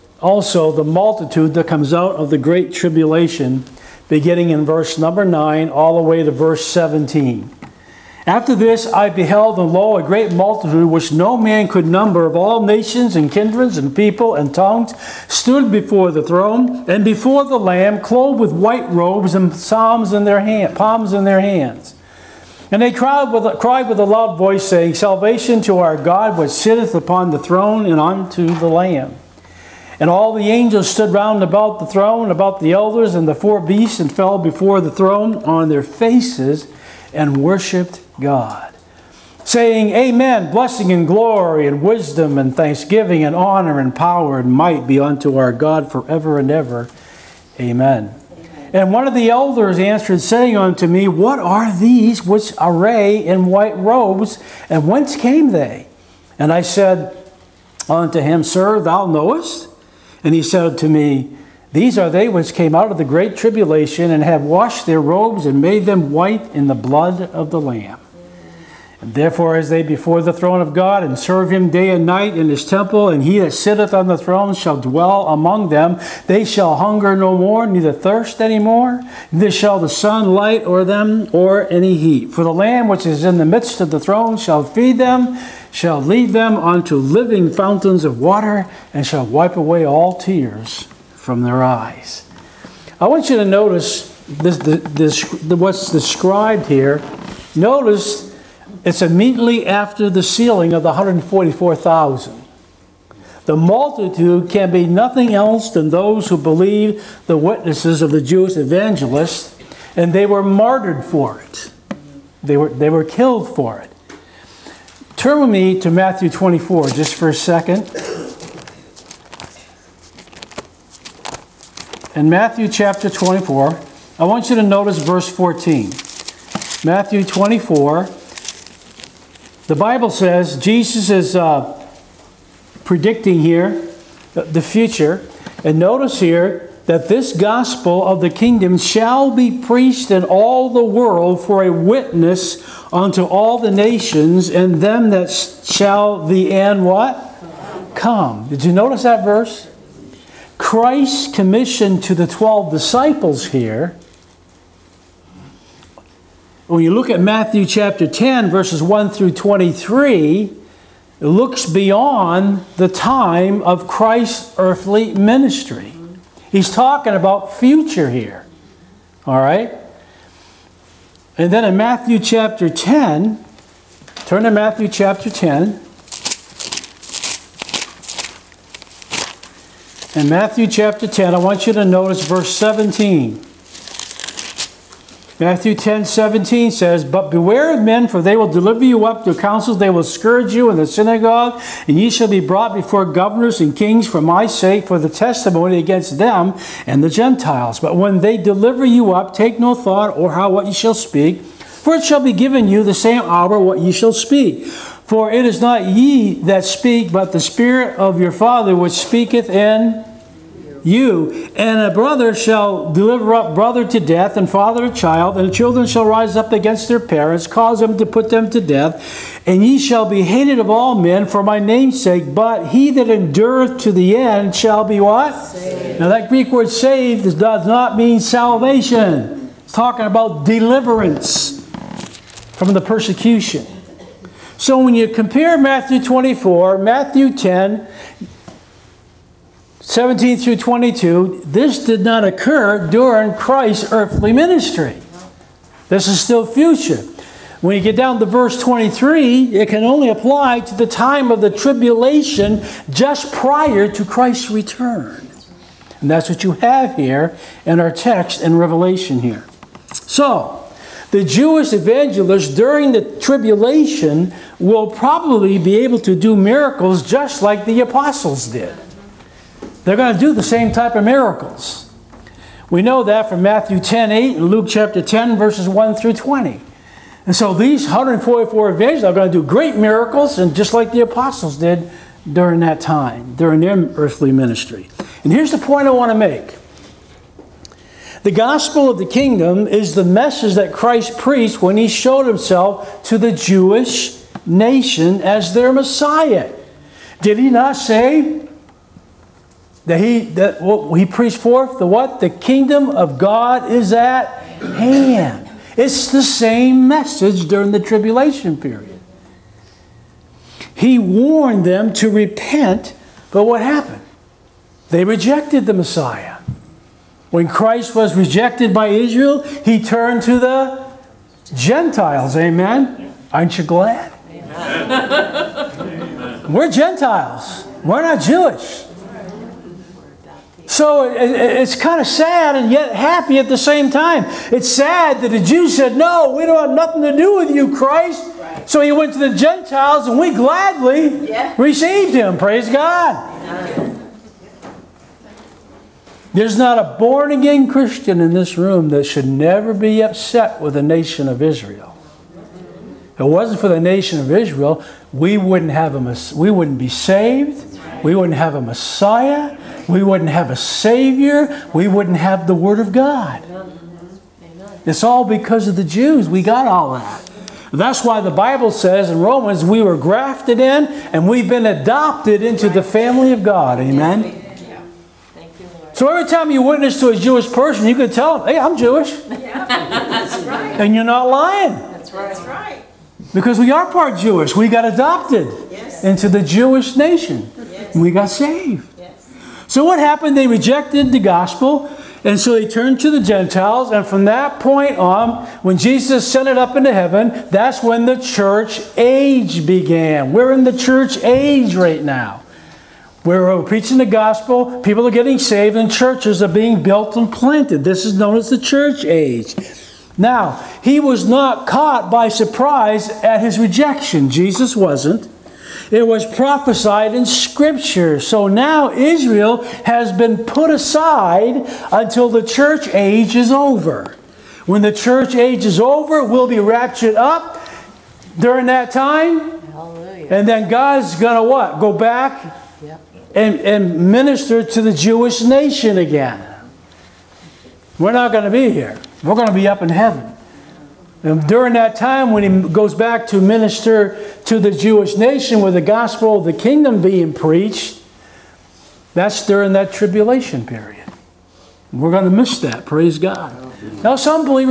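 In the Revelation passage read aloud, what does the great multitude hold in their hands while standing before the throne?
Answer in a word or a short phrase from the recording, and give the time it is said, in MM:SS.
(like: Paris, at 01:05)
palms, at 00:20.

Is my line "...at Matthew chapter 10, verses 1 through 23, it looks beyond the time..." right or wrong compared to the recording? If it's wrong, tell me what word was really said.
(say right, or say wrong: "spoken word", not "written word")
right.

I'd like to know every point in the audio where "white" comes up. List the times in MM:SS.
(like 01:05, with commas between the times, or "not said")
00:18, 00:53, 01:06.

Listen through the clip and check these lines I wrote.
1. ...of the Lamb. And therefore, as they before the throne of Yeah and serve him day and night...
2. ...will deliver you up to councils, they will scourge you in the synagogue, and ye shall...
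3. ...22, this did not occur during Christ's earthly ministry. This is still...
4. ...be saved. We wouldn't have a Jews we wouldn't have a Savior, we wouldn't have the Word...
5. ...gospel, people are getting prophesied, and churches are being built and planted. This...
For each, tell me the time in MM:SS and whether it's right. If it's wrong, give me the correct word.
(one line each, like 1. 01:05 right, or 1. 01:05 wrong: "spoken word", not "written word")
1. 01:07 wrong: "God", not "Yeah"
2. 03:08 right
3. 04:00 right
4. 05:56 wrong: "Messiah", not "Jews"
5. 06:44 wrong: "saved", not "prophesied".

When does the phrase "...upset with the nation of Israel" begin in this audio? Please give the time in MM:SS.
05:50.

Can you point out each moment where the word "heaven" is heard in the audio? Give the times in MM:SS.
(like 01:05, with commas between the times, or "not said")
06:36, 07:19.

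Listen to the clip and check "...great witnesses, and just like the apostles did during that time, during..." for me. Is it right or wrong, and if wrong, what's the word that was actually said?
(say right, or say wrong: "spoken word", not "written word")
wrong: "miracles", not "witnesses".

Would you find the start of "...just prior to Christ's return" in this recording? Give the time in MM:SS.
04:12.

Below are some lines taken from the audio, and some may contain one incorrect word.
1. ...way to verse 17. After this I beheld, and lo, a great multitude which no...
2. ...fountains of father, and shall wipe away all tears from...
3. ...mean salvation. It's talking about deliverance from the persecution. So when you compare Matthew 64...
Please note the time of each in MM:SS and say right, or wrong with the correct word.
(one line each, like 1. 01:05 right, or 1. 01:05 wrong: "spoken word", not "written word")
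1. 00:06 right
2. 01:27 wrong: "water", not "father"
3. 03:47 wrong: "24", not "64".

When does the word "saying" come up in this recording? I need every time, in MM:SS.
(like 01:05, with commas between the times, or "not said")
00:24, 00:39, 00:50.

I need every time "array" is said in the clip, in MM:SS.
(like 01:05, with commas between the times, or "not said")
00:52.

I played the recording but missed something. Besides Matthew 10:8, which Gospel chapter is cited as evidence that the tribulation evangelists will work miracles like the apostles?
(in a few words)
Luke chapter 10.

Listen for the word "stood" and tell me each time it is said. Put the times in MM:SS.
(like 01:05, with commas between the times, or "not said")
00:15, 00:30.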